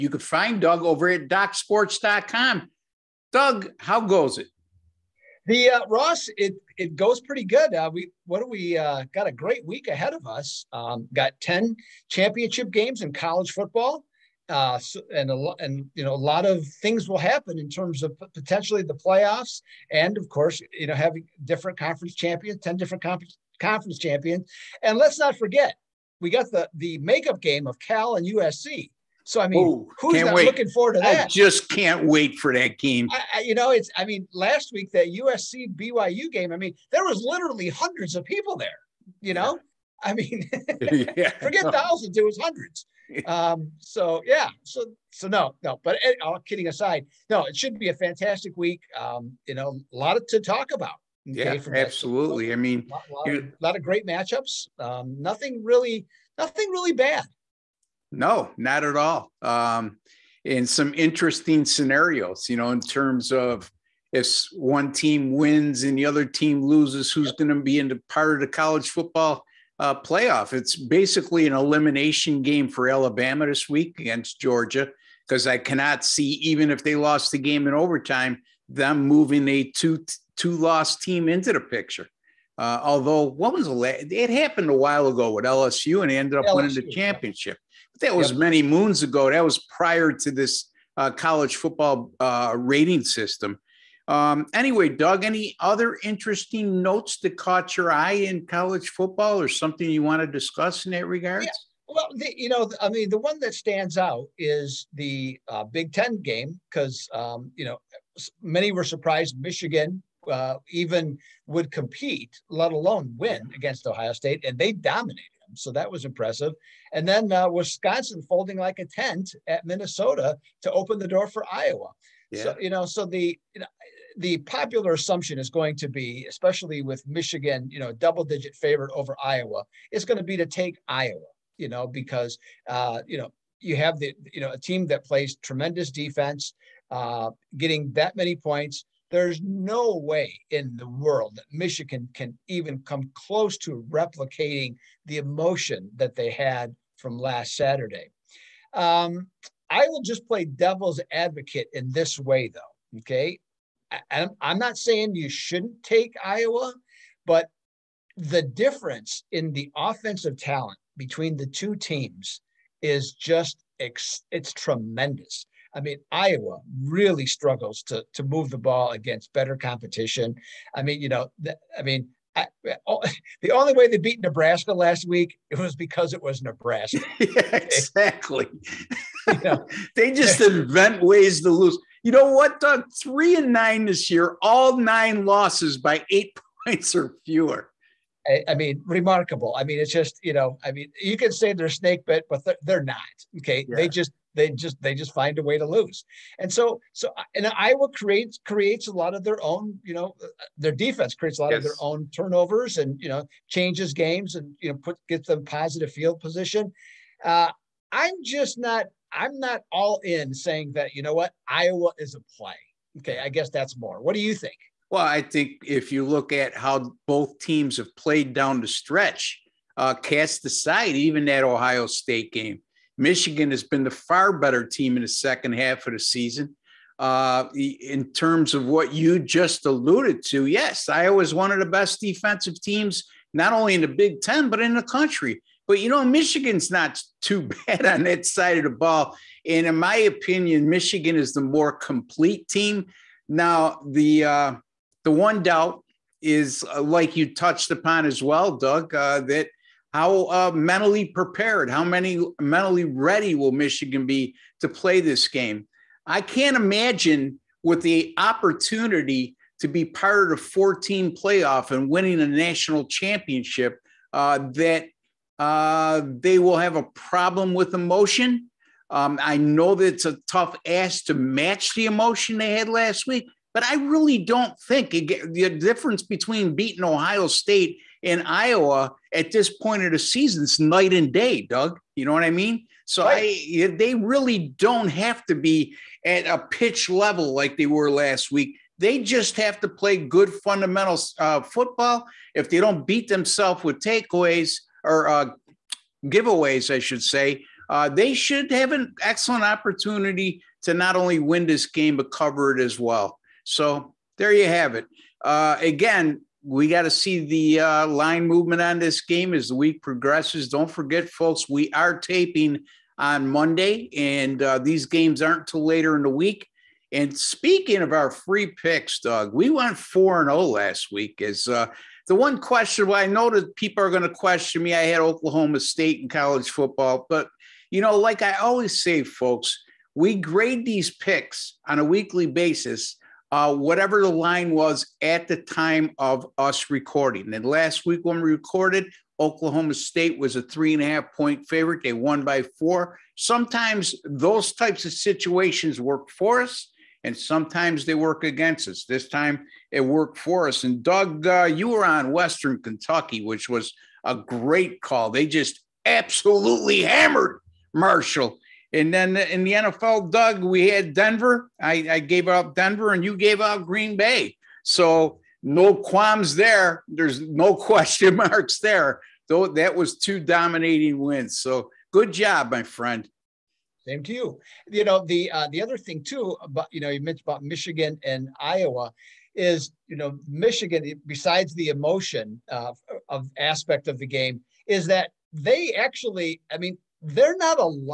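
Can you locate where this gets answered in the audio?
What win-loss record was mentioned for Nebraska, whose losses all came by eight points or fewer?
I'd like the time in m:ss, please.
3:03.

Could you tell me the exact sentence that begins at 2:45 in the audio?
I mean, Iowa really struggles to to move the ball against better competition.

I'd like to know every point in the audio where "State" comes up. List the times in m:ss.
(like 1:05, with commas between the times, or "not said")
1:54, 3:41, 4:37, 5:25, 5:39.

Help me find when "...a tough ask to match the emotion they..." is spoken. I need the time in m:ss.
4:30.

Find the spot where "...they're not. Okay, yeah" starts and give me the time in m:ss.
3:12.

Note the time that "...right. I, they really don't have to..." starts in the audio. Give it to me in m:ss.
4:43.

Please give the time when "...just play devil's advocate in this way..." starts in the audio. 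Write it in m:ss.
2:30.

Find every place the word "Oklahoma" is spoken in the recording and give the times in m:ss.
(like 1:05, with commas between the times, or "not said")
5:25, 5:39.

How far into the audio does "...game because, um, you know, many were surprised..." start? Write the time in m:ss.
1:46.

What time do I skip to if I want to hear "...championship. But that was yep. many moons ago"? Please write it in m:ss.
1:26.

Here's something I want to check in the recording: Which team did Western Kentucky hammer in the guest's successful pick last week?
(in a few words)
Marshall.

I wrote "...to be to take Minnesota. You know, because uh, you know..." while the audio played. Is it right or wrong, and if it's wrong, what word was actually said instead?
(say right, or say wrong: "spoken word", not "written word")
wrong: "Iowa", not "Minnesota".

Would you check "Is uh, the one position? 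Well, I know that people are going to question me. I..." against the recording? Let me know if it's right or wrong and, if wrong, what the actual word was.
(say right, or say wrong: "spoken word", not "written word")
wrong: "question", not "position".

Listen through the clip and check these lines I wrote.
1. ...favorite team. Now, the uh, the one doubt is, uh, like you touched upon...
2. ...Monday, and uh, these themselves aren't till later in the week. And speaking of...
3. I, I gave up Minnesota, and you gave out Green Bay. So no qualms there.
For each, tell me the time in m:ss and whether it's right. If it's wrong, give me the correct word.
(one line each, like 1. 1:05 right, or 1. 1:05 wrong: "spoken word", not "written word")
1. 4:01 wrong: "complete", not "favorite"
2. 5:13 wrong: "games", not "themselves"
3. 6:01 wrong: "Denver", not "Minnesota".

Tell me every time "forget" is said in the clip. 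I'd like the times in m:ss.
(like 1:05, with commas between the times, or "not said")
0:25, 0:41, 5:10.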